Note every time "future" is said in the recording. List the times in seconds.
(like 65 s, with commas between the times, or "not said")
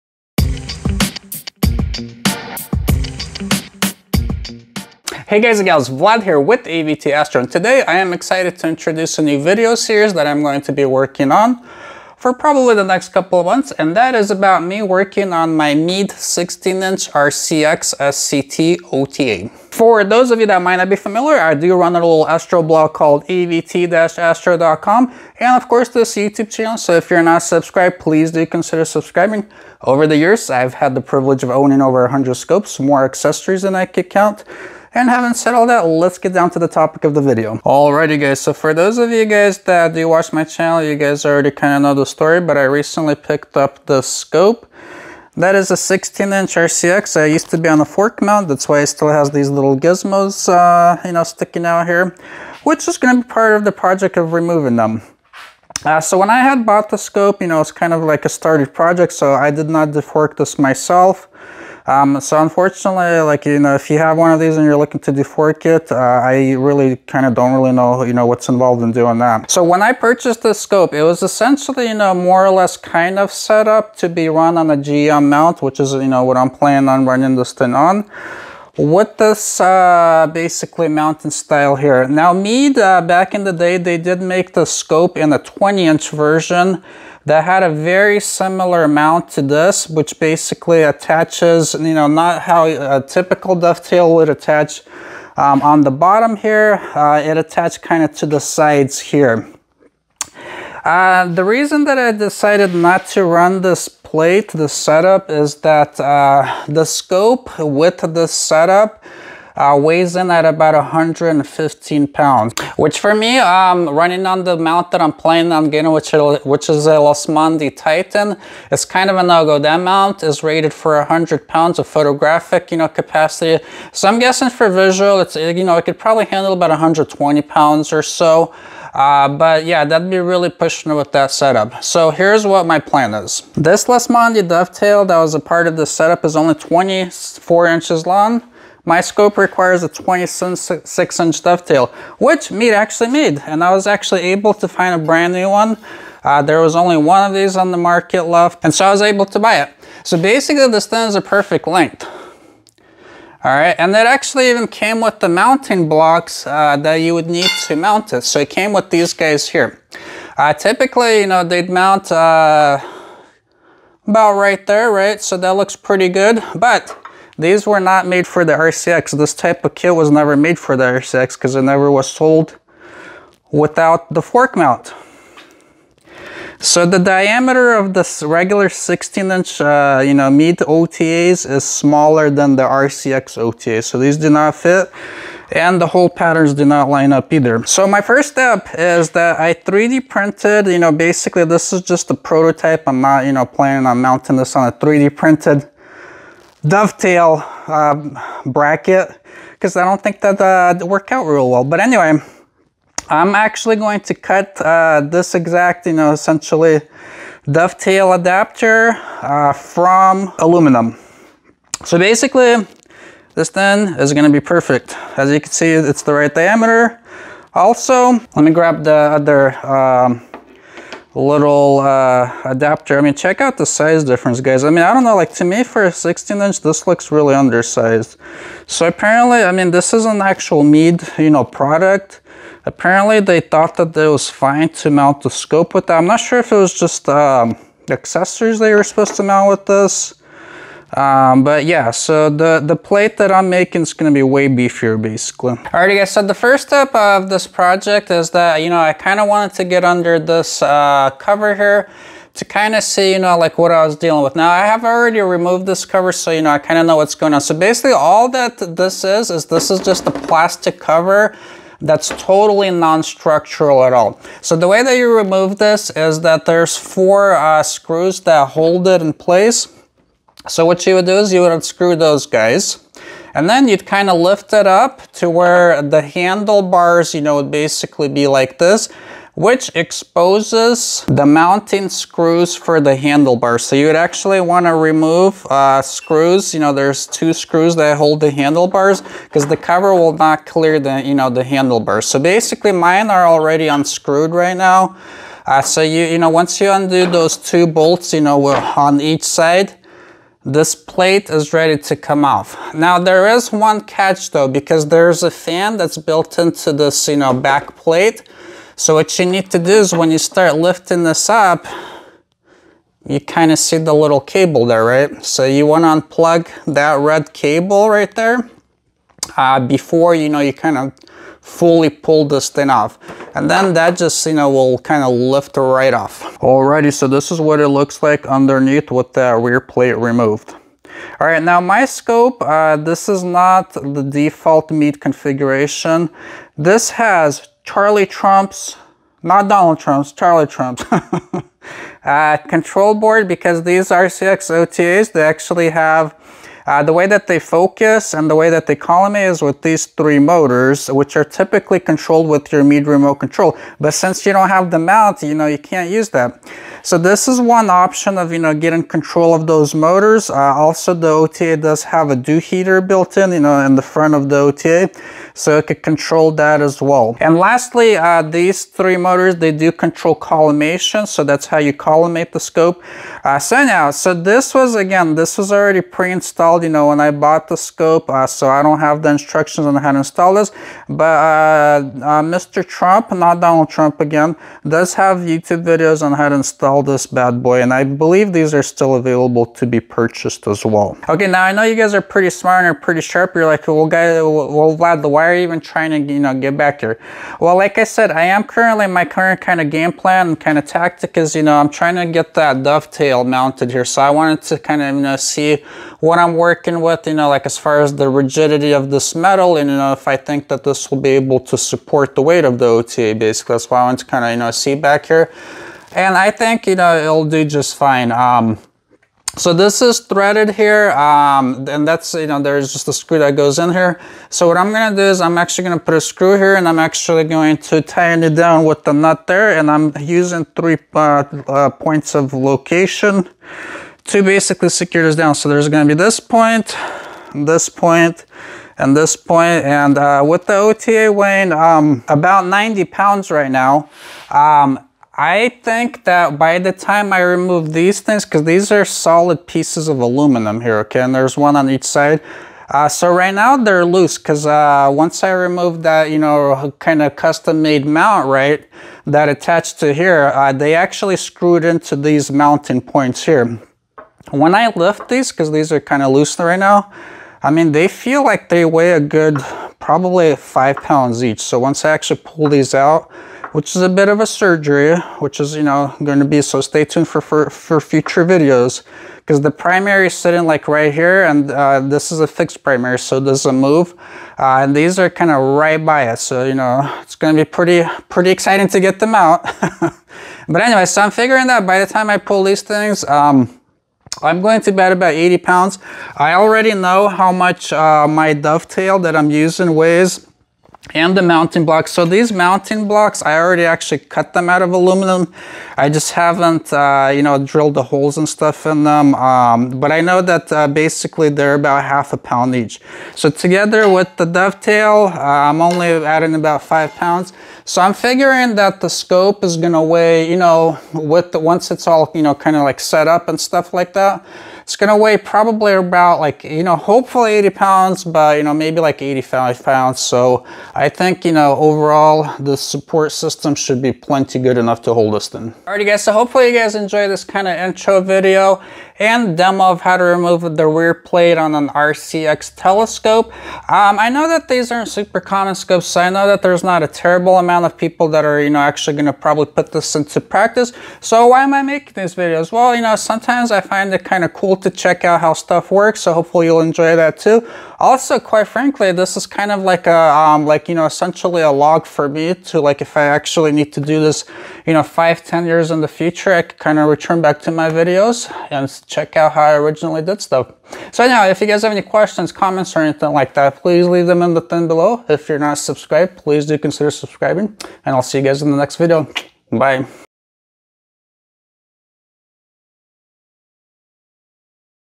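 477 s, 565 s.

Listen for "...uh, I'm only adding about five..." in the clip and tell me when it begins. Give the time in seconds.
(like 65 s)
515 s.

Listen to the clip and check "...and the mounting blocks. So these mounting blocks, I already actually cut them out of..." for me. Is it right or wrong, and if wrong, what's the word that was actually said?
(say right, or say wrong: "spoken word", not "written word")
right.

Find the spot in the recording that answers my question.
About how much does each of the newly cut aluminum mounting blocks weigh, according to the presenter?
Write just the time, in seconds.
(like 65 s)
511 s.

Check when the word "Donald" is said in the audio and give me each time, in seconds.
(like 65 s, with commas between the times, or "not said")
339 s, 383 s.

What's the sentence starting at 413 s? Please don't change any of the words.
That's why I want to kind of, you know, see back here.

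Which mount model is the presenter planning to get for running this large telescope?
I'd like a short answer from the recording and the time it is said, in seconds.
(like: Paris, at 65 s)
Losmandy Titan, at 117 s.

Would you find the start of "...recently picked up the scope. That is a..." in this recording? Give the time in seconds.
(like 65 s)
42 s.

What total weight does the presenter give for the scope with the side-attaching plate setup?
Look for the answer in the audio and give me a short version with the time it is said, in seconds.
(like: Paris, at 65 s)
115 pounds, at 110 s.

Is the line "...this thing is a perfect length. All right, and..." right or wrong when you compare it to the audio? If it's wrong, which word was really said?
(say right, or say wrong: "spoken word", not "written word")
right.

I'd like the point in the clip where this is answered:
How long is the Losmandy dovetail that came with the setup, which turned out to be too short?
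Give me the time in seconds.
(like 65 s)
136 s.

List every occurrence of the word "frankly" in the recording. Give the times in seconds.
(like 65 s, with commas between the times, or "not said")
558 s.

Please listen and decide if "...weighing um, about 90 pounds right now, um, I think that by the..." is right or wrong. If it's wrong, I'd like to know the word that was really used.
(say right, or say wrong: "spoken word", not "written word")
right.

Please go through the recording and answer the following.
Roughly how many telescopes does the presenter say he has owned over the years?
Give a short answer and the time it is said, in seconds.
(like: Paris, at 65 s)
over 100, at 31 s.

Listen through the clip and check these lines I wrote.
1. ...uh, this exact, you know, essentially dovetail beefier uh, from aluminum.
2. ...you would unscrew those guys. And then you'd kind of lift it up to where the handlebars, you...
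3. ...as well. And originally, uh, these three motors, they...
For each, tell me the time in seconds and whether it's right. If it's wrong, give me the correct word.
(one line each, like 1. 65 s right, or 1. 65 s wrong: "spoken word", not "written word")
1. 204 s wrong: "adapter", not "beefier"
2. 271 s right
3. 366 s wrong: "lastly", not "originally".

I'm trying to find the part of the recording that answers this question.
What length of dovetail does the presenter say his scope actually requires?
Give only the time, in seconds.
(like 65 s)
139 s.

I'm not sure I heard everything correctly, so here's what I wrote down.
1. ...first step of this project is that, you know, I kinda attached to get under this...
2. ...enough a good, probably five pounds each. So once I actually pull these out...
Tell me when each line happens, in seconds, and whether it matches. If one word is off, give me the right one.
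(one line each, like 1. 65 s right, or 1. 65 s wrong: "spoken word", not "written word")
1. 246 s wrong: "wanted", not "attached"
2. 468 s wrong: "weigh", not "enough".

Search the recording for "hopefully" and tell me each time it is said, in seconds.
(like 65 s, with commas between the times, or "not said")
526 s, 536 s, 556 s.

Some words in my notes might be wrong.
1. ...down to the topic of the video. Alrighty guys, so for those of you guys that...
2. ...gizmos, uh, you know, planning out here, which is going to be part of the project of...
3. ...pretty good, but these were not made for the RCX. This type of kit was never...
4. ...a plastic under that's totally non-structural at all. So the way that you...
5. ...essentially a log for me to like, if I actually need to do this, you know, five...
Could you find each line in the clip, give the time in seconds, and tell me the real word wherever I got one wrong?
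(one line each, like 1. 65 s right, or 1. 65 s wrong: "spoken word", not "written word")
1. 36 s right
2. 49 s wrong: "sticking", not "planning"
3. 165 s right
4. 260 s wrong: "cover", not "under"
5. 560 s right.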